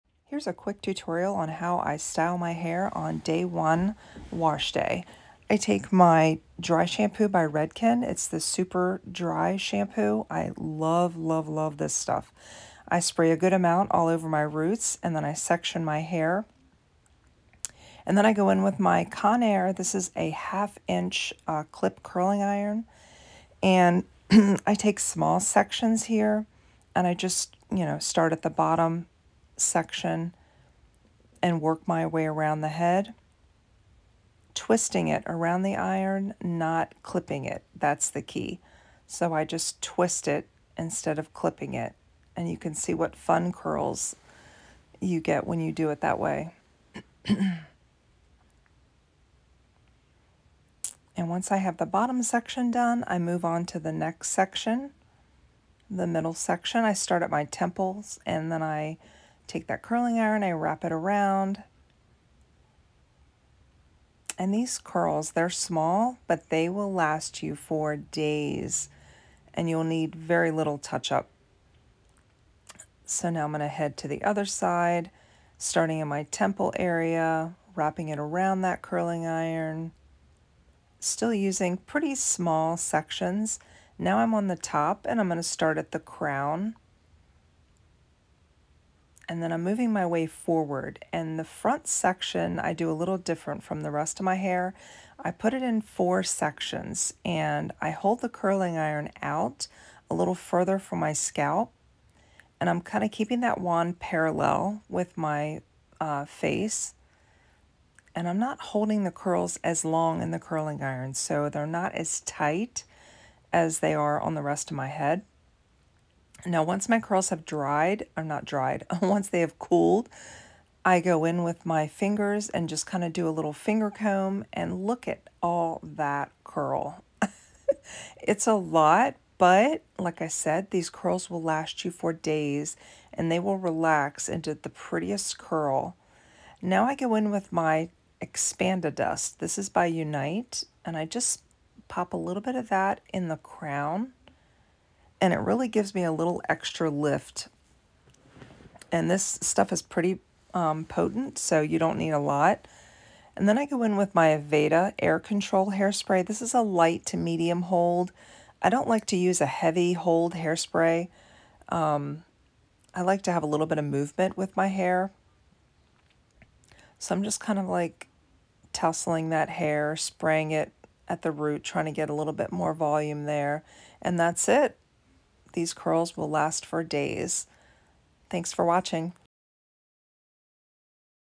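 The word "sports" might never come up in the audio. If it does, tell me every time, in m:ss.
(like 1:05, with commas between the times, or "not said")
not said.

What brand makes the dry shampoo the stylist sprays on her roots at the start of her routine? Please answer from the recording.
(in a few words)
Redken.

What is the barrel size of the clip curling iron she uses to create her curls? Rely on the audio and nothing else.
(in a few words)
half inch.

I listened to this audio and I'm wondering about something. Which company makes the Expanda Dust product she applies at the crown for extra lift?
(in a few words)
Unite.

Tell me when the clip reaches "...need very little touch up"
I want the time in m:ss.
1:09.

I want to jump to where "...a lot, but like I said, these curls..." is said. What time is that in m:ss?
2:08.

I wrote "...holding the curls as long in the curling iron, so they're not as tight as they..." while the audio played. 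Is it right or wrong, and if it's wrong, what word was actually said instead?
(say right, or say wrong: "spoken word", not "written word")
right.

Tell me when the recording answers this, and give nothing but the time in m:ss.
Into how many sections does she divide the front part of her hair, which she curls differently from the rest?
1:35.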